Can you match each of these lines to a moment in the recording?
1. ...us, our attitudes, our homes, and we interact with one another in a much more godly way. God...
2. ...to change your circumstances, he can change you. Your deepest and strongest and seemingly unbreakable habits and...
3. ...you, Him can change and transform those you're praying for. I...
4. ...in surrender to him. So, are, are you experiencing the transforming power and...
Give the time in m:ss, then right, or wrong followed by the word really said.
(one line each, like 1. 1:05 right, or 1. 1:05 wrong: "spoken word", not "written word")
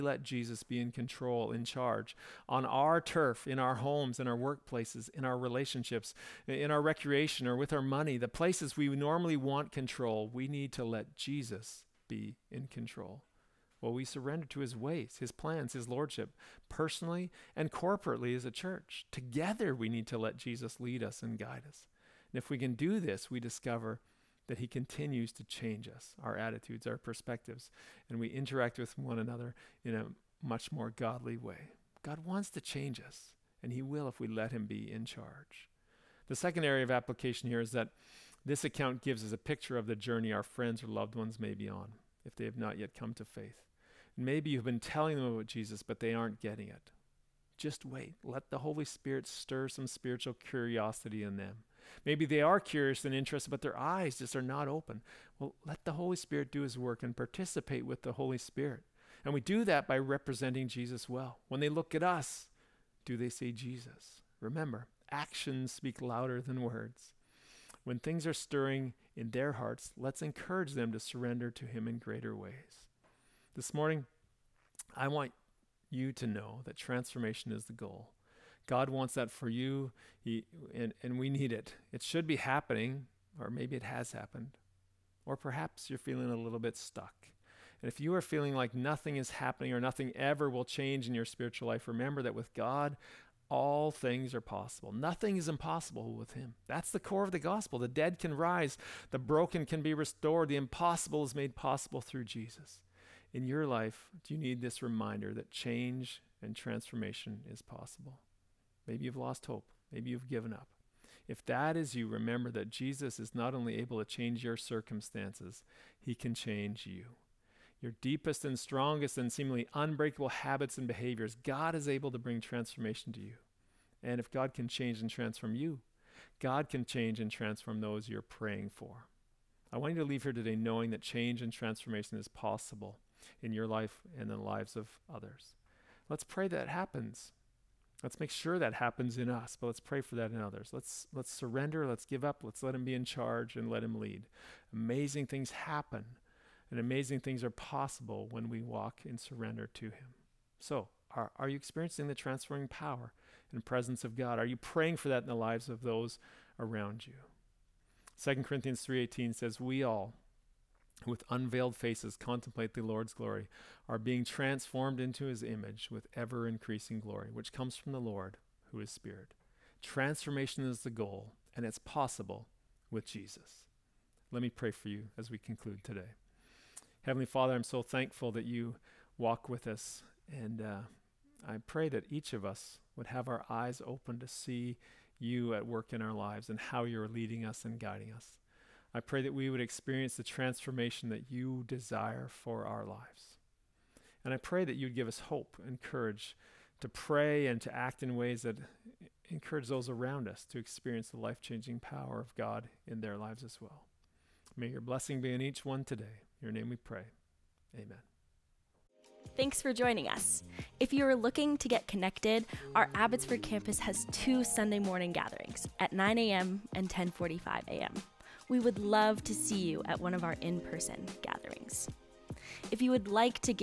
1. 0:25 wrong: "perspectives", not "homes"
2. 1:53 right
3. 2:05 wrong: "God", not "Him"
4. 2:29 right.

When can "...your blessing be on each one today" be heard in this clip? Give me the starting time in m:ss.
3:24.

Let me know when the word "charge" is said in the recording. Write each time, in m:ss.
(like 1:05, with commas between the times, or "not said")
0:01, 0:35, 2:23.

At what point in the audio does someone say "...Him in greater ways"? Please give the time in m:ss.
1:11.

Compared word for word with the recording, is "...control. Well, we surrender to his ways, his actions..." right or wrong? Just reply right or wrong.
wrong.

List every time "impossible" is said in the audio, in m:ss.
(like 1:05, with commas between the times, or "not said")
1:35, 1:40.